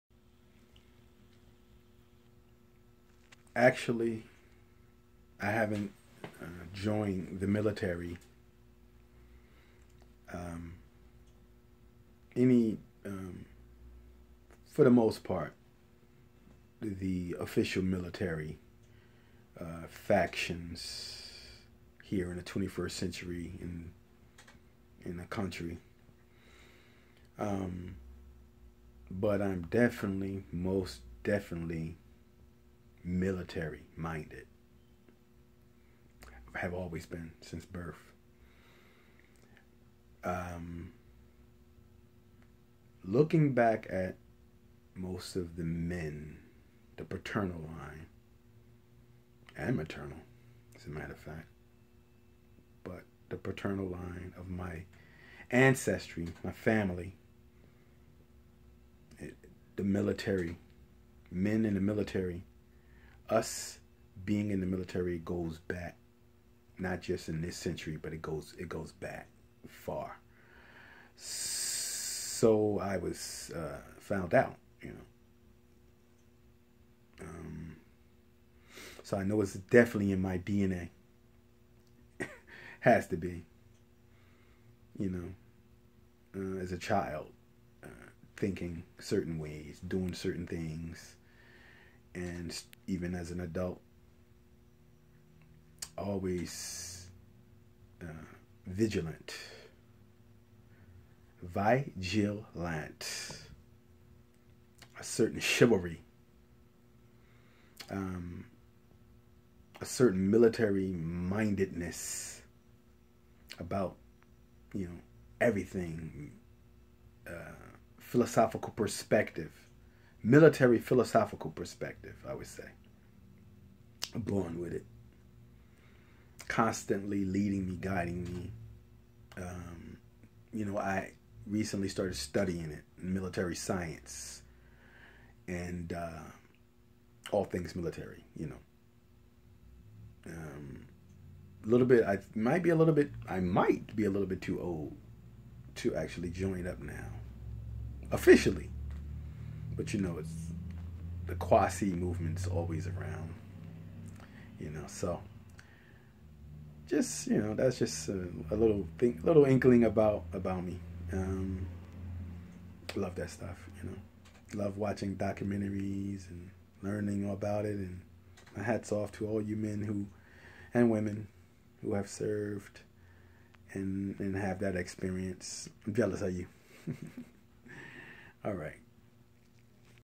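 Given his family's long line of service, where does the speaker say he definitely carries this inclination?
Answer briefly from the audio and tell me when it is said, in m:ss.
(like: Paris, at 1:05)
DNA, at 1:20.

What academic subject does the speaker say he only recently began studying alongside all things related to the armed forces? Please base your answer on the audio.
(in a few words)
Military science.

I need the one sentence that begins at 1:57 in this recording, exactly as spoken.
Uh, philosophical perspective military philosophical perspective, I would say.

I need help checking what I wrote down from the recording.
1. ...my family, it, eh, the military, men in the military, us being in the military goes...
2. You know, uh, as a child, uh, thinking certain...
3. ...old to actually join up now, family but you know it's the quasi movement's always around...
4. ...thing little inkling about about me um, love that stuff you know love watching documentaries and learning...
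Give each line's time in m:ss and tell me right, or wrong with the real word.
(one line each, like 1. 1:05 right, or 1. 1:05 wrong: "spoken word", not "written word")
1. 0:56 right
2. 1:24 right
3. 2:24 wrong: "officially", not "family"
4. 2:38 right.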